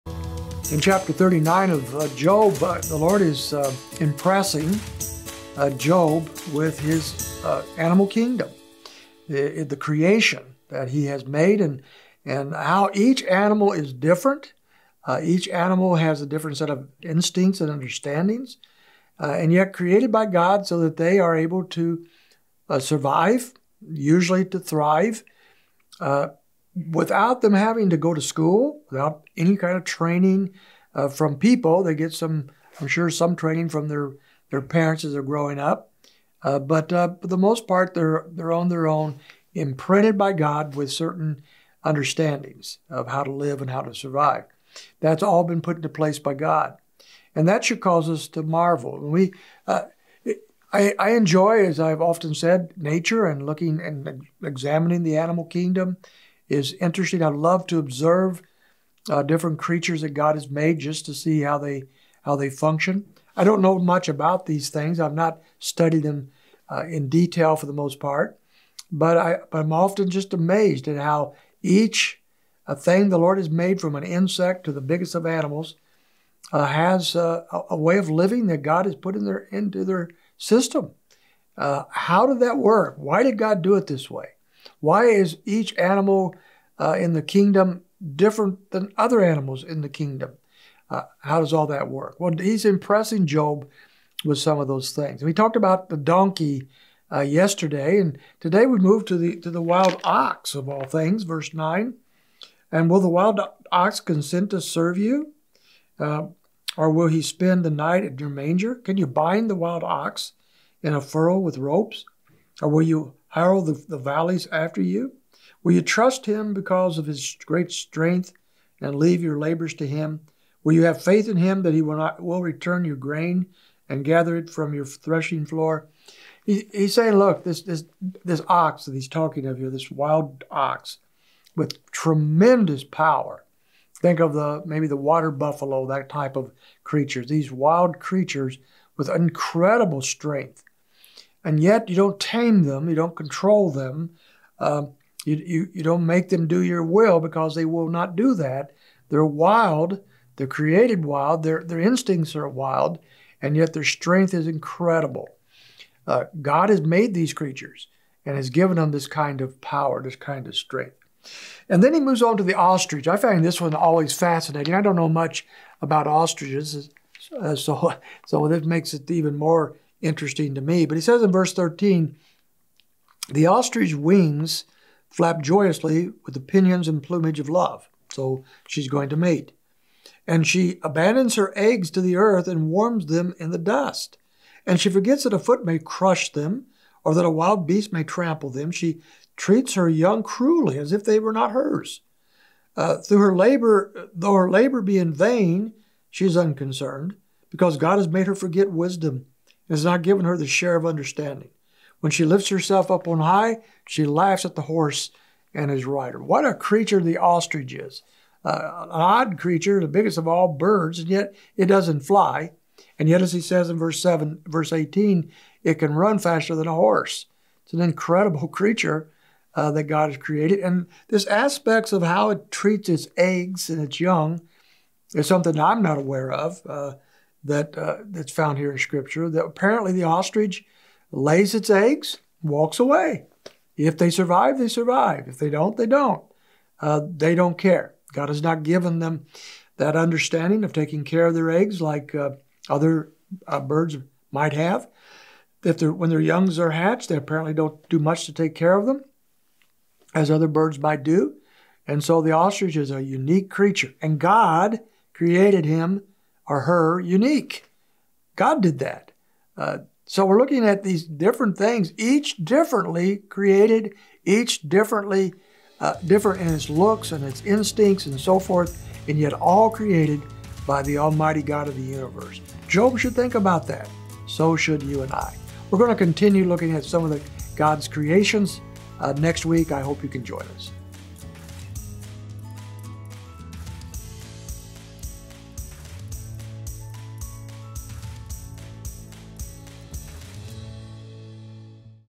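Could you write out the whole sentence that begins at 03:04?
And she forgets that a foot may crush them or that a wild beast may trample them.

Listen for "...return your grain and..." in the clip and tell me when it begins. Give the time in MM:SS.
02:02.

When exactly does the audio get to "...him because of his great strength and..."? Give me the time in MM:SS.
01:56.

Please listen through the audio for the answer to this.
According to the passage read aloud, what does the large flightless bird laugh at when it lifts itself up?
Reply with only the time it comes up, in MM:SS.
03:24.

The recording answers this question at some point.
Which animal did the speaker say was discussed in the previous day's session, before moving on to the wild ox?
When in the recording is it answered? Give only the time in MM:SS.
01:35.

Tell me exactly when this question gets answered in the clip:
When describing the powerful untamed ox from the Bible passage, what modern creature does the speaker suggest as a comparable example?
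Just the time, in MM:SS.
02:14.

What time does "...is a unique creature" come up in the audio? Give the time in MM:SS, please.
04:12.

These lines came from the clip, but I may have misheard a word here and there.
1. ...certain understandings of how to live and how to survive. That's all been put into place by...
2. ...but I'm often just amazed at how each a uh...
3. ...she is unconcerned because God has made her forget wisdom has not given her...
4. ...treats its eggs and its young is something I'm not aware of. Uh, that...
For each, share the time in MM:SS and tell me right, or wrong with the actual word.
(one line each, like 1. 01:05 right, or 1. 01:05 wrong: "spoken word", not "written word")
1. 00:40 right
2. 01:09 right
3. 03:16 right
4. 03:42 right.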